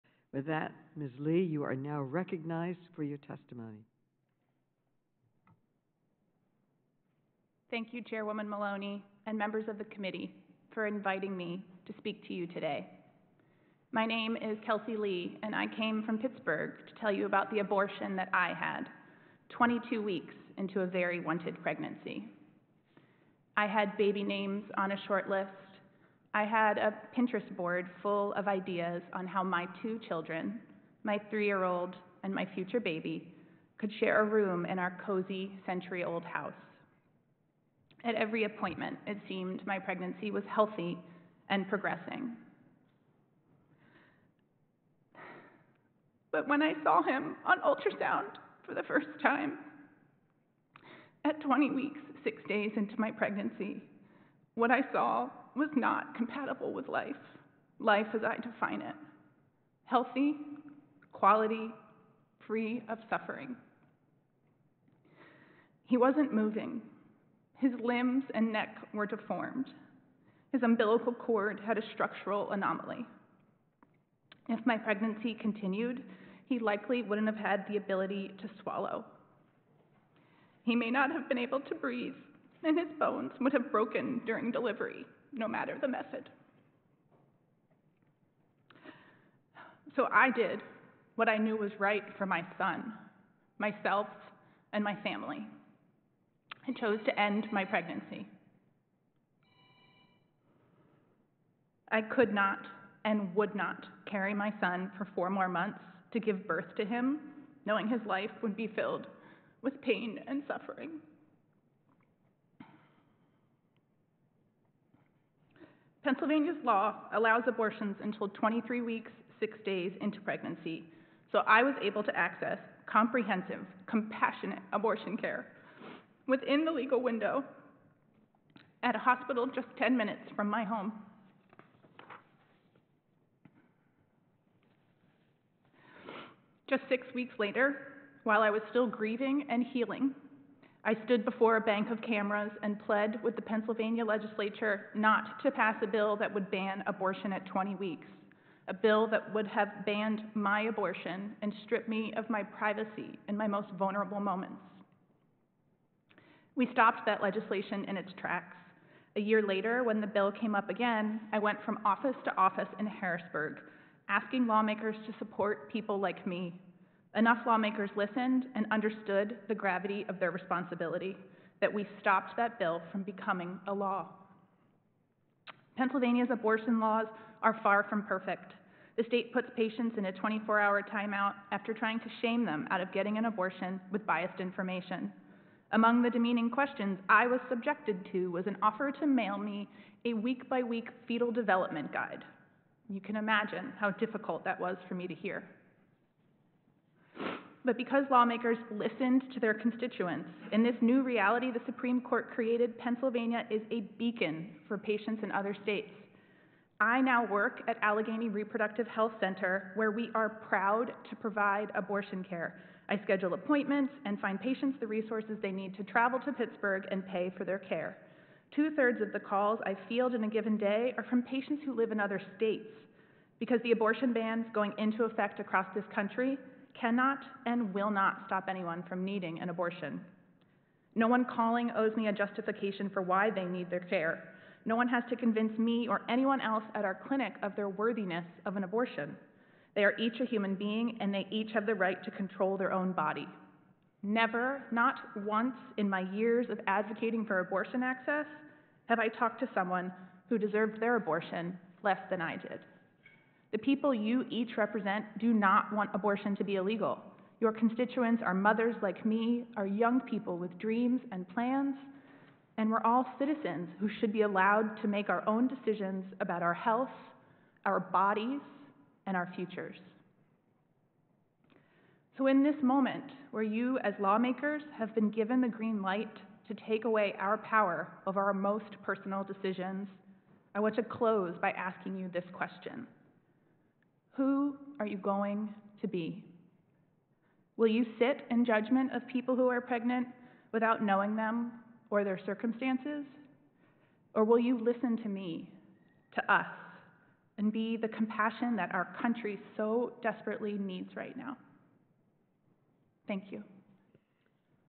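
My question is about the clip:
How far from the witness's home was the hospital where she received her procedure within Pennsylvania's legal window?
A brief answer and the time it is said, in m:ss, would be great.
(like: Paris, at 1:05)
10 minutes, at 2:09.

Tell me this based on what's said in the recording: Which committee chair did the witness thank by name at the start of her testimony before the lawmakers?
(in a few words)
Maloney.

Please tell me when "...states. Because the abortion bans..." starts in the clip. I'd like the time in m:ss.
3:42.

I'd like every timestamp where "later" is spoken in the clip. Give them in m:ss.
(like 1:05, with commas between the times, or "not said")
2:17, 2:39.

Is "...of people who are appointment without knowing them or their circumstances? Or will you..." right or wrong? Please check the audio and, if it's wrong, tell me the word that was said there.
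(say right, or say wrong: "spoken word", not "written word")
wrong: "pregnant", not "appointment".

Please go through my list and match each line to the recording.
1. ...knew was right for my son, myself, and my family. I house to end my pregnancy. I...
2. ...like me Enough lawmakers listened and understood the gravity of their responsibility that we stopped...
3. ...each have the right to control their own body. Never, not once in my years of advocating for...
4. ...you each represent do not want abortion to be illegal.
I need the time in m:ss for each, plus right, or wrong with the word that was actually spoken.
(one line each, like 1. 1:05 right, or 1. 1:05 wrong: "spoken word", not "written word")
1. 1:31 wrong: "chose", not "house"
2. 2:45 right
3. 4:01 right
4. 4:13 right.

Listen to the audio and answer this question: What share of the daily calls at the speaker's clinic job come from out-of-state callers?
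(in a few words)
Two thirds.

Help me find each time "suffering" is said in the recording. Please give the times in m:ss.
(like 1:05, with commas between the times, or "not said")
1:03, 1:50.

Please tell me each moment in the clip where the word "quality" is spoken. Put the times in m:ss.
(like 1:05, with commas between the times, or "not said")
1:01.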